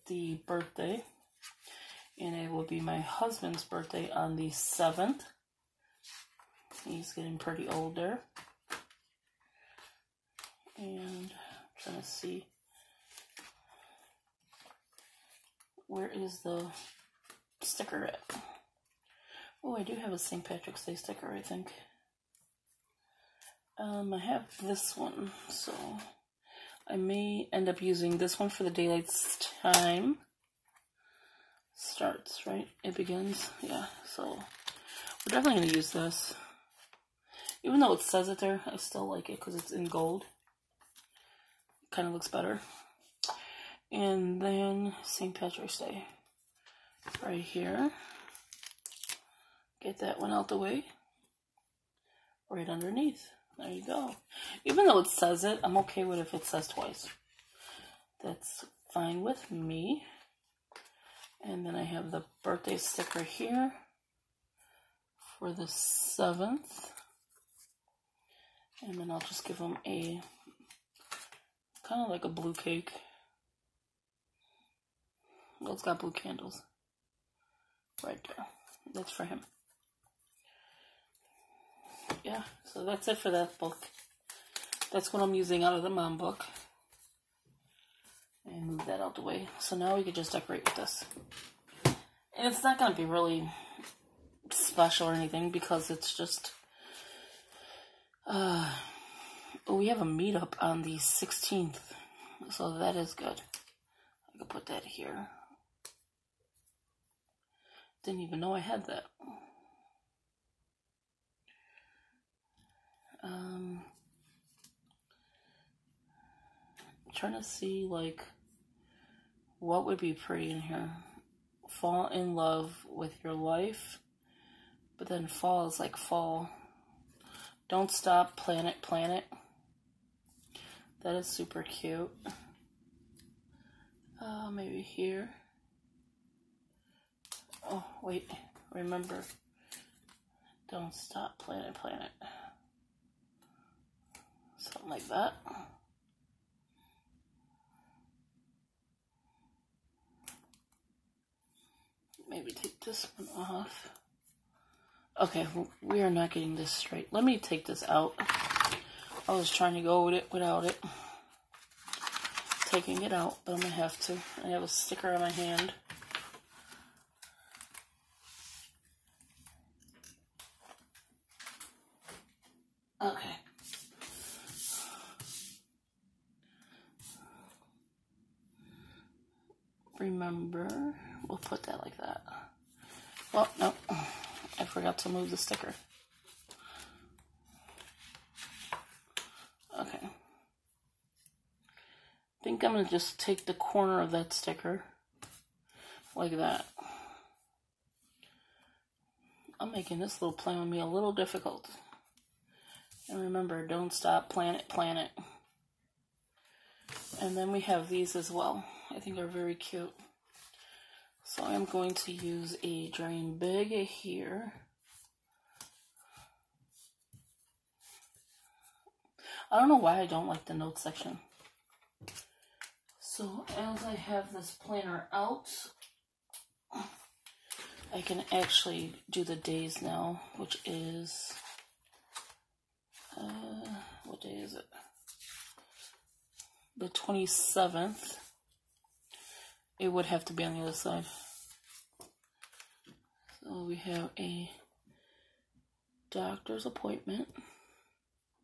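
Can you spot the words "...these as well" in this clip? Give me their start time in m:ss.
3:27.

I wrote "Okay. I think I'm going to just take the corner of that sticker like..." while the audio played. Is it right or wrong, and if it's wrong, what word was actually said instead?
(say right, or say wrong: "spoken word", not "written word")
right.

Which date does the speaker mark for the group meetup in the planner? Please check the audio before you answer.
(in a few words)
16th.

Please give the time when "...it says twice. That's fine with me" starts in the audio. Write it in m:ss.
0:56.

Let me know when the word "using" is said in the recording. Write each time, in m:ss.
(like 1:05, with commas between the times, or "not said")
0:27, 1:25.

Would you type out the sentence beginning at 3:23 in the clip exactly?
And remember, don't stop, planet, planet.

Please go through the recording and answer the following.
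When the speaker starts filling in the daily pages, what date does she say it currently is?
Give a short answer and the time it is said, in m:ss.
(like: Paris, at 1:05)
27th, at 3:56.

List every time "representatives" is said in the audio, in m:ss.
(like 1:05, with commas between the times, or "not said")
not said.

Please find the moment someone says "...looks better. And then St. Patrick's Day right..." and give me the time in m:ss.
0:42.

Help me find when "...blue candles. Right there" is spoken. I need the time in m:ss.
1:15.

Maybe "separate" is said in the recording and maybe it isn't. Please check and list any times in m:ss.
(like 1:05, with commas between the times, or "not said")
not said.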